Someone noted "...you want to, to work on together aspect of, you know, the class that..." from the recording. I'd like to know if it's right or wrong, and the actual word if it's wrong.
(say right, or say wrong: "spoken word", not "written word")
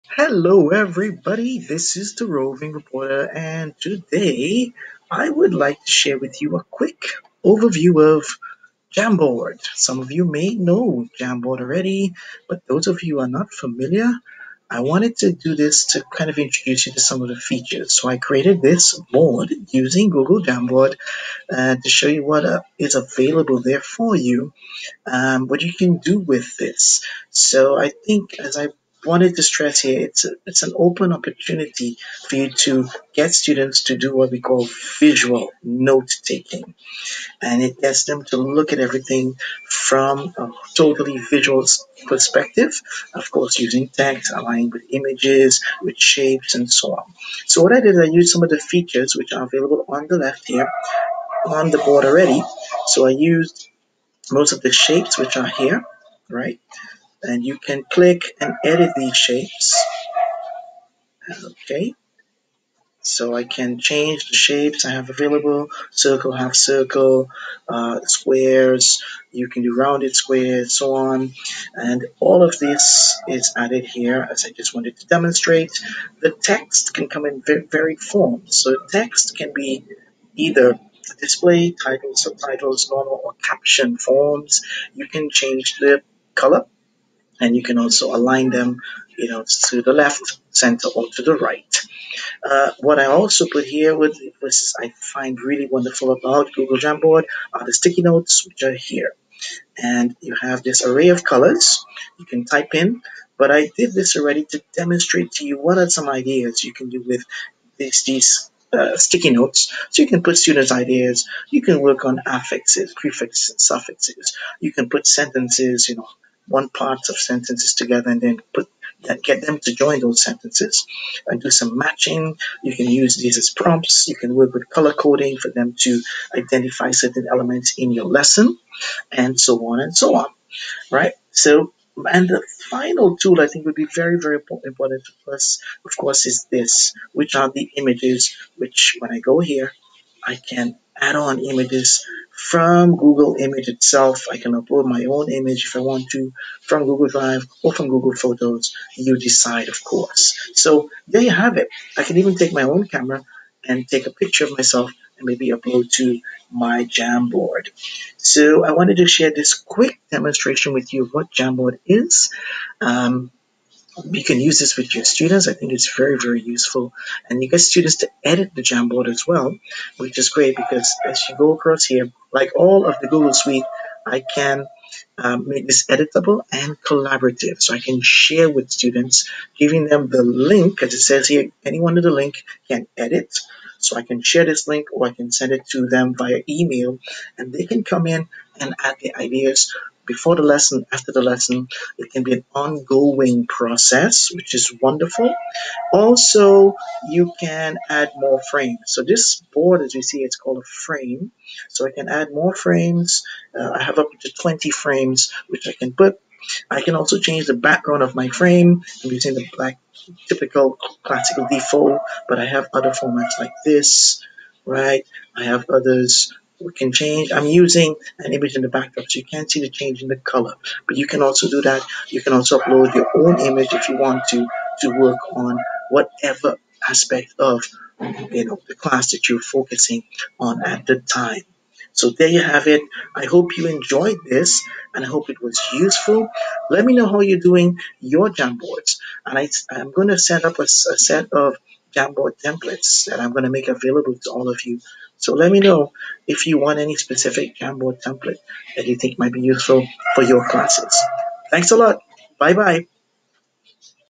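wrong: "whatever", not "together".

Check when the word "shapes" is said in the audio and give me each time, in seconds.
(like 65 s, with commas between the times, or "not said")
45 s, 54 s, 59 s, 64 s.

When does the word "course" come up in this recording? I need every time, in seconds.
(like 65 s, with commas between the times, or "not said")
43 s, 135 s, 149 s.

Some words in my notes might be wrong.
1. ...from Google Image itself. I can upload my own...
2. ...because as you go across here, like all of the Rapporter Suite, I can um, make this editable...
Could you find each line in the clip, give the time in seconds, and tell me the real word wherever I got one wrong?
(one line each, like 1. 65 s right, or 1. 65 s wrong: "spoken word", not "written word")
1. 142 s right
2. 170 s wrong: "Google", not "Rapporter".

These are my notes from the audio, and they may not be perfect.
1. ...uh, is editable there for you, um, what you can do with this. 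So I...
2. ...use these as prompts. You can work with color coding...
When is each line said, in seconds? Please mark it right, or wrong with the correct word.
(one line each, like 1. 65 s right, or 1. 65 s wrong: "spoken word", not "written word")
1. 22 s wrong: "available", not "editable"
2. 122 s right.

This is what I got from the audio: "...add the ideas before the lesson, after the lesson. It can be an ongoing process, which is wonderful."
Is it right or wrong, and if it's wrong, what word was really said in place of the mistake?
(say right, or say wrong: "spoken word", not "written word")
right.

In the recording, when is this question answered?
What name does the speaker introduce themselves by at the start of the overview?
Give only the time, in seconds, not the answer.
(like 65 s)
2 s.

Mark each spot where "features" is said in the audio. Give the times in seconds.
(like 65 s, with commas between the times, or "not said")
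17 s, 48 s.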